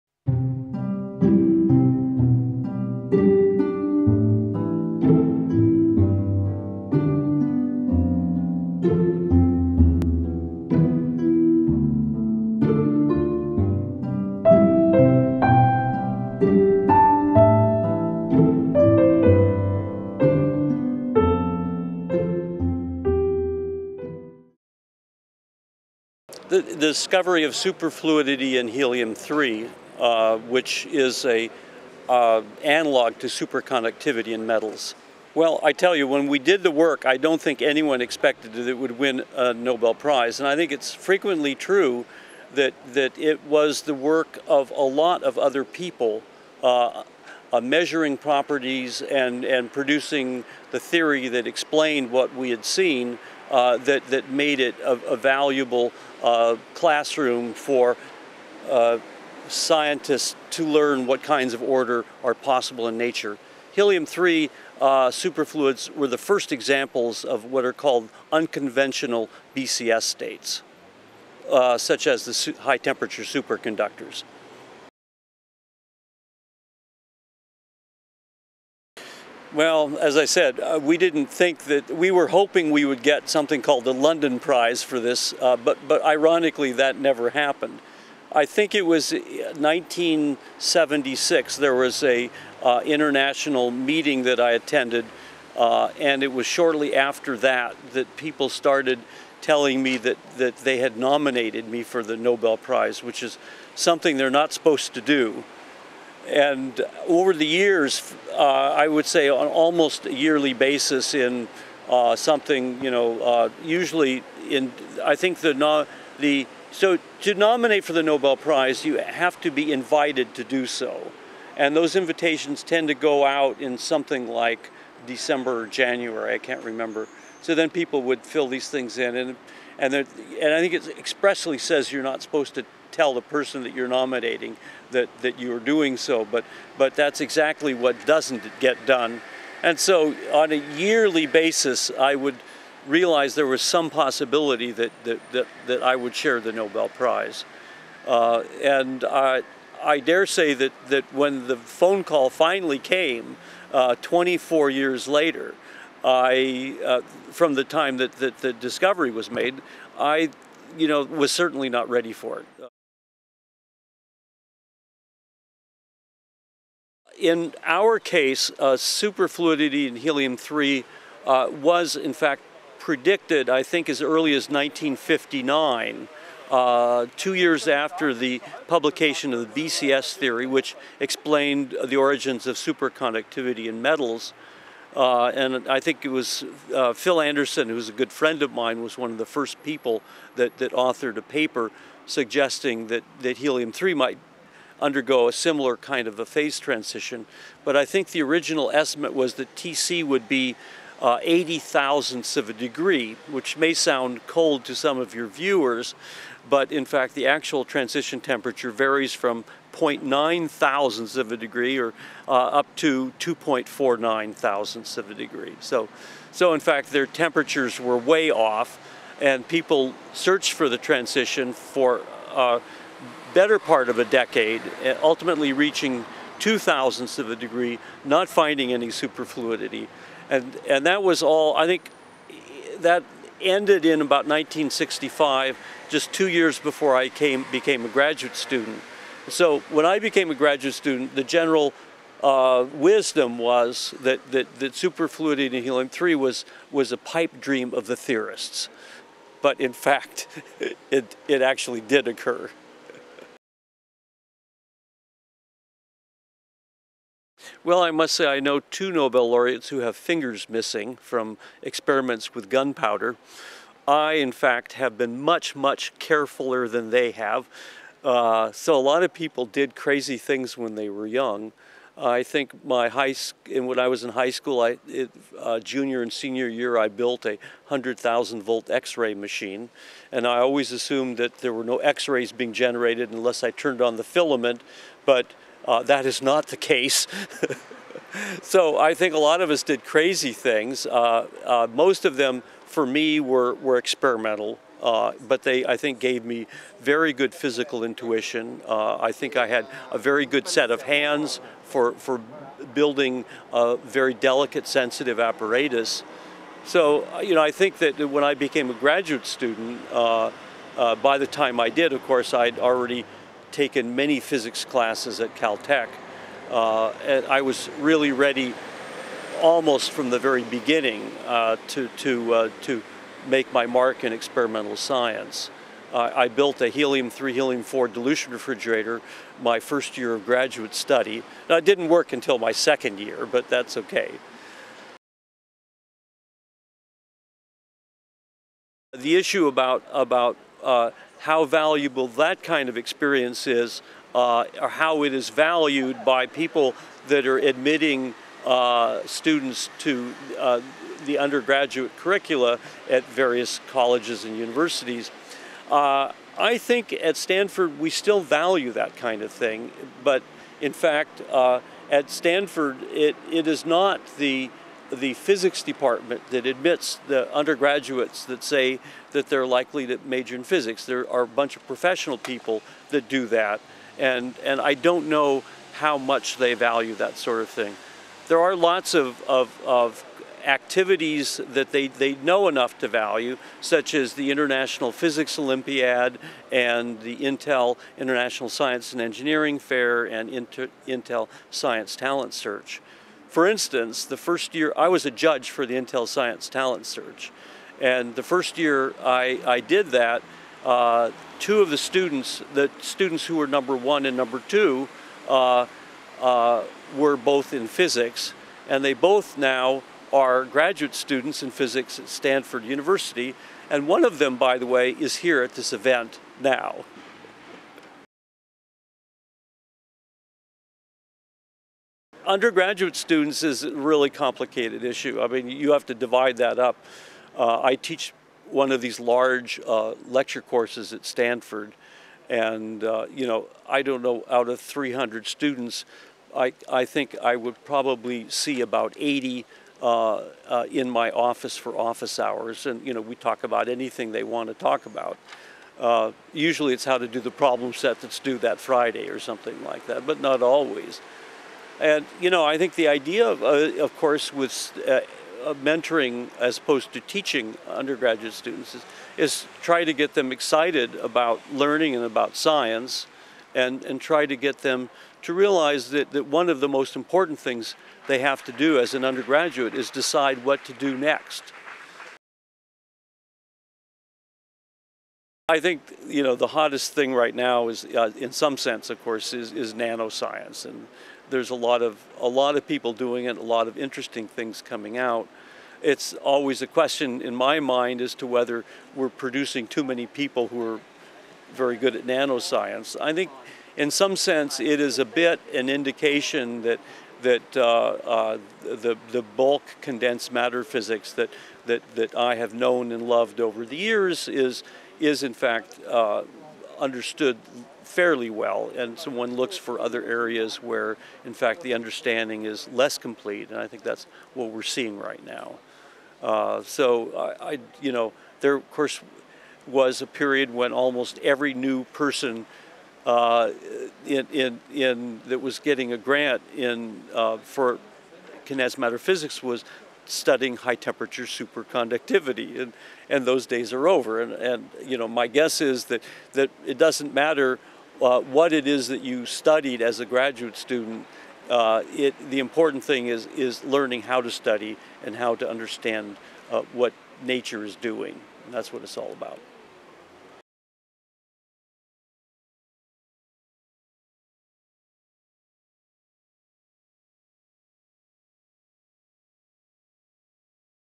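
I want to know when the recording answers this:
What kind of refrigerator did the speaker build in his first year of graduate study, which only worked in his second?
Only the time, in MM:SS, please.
05:26.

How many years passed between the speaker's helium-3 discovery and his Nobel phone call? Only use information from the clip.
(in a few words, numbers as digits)
24.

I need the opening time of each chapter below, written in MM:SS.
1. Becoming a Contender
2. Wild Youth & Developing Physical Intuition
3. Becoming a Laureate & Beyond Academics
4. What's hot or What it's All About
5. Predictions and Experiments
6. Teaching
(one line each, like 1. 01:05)
1. 01:18
2. 04:14
3. 05:36
4. 07:52
5. 02:43
6. 06:59.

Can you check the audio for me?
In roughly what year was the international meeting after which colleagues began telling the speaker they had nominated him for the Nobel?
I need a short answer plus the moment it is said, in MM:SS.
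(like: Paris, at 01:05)
1976, at 01:29.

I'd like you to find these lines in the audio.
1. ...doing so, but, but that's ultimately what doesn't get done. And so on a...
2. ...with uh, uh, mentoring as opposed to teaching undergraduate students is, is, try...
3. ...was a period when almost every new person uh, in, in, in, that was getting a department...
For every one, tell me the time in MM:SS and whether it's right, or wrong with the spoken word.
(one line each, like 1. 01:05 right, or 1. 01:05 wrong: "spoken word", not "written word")
1. 02:15 wrong: "exactly", not "ultimately"
2. 07:34 right
3. 08:39 wrong: "grant", not "department".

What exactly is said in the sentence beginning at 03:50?
And, and that was all, I think that ended in about 1965, just two years before I came, became a graduate student.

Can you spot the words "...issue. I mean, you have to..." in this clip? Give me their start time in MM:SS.
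07:04.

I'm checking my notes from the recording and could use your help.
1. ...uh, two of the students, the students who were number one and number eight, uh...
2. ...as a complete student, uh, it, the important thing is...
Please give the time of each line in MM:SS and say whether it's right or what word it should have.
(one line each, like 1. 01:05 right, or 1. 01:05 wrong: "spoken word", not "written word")
1. 06:40 wrong: "two", not "eight"
2. 08:59 wrong: "graduate", not "complete".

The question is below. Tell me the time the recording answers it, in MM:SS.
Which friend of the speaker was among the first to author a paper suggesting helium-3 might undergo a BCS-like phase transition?
03:06.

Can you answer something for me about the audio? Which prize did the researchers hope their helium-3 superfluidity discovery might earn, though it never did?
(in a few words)
London Prize.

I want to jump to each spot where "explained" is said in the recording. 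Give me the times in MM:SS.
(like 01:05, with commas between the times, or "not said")
00:51, 03:00.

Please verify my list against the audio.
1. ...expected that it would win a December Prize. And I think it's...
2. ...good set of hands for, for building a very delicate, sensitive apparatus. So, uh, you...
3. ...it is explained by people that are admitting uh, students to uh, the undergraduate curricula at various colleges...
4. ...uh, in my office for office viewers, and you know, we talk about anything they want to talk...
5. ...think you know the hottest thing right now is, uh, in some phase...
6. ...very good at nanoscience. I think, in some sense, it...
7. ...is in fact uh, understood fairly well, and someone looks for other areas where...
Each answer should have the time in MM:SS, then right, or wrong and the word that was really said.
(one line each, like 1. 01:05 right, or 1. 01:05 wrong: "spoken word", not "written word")
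1. 00:38 wrong: "Nobel", not "December"
2. 05:00 right
3. 05:45 wrong: "valued", not "explained"
4. 07:20 wrong: "hours", not "viewers"
5. 07:55 wrong: "sense", not "phase"
6. 08:11 right
7. 08:24 right.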